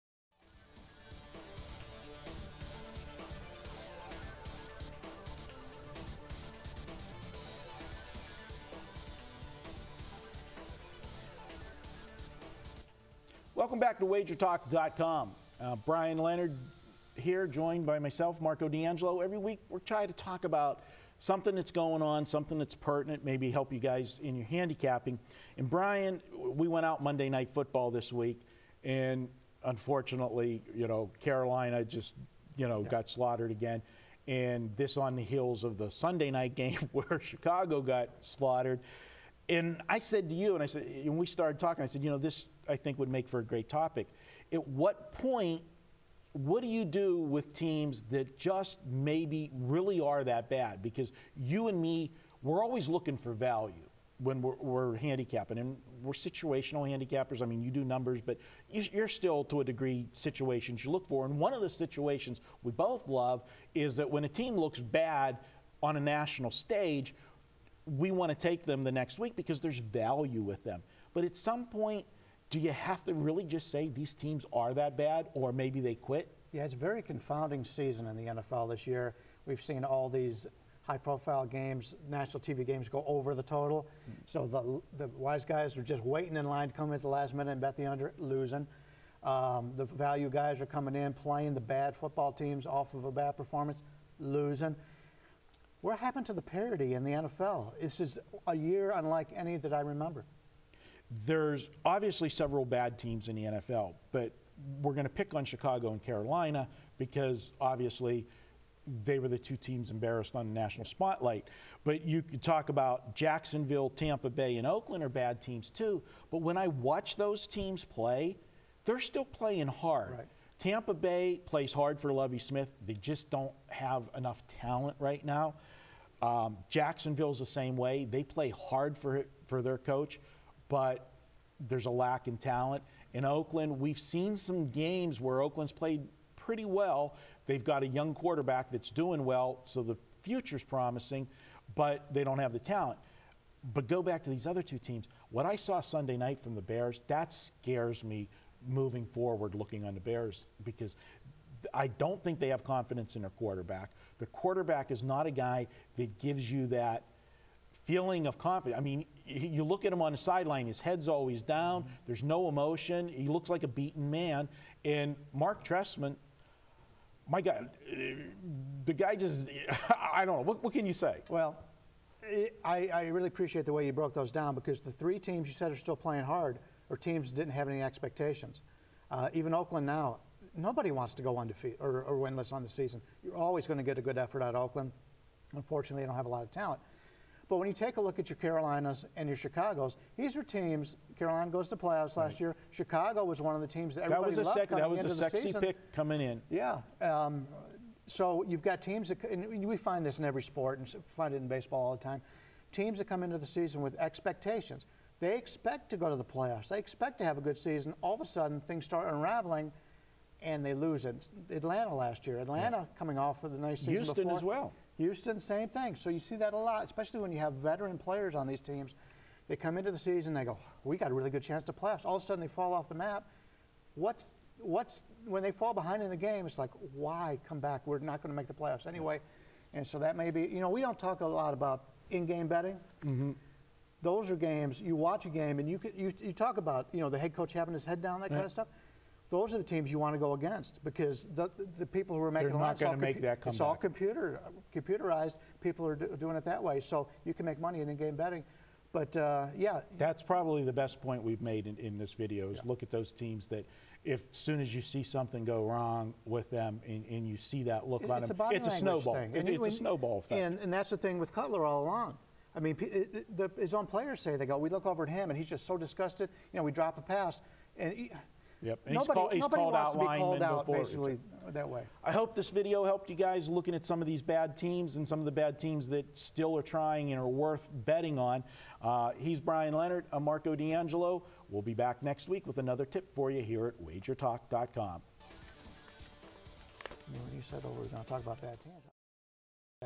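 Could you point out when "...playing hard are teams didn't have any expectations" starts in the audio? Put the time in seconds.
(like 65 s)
175 s.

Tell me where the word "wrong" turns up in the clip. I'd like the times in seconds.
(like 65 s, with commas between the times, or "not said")
255 s.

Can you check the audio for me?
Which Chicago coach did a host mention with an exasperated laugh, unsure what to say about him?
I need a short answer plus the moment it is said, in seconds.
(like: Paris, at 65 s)
Marc Trestman, at 165 s.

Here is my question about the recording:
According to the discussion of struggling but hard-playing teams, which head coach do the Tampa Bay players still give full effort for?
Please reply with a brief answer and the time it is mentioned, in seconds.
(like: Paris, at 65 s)
Lovie Smith, at 122 s.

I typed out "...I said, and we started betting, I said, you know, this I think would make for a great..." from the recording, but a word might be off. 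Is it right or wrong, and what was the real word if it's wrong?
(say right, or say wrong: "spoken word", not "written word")
wrong: "talking", not "betting".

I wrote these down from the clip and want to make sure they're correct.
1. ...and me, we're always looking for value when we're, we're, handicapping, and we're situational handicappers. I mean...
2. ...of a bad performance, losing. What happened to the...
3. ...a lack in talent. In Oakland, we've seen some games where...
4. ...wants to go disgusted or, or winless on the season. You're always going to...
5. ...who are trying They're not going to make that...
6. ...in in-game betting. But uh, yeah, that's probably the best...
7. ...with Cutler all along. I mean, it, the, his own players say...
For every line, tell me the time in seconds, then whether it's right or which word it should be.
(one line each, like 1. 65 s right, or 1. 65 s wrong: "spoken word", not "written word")
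1. 51 s right
2. 92 s right
3. 131 s right
4. 180 s wrong: "undefeated", not "disgusted"
5. 242 s wrong: "making", not "trying"
6. 247 s right
7. 261 s right.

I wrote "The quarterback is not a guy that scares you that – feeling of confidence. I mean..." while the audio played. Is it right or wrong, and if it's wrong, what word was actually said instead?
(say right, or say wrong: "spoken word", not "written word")
wrong: "gives", not "scares".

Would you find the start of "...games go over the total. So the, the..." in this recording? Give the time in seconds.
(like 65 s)
82 s.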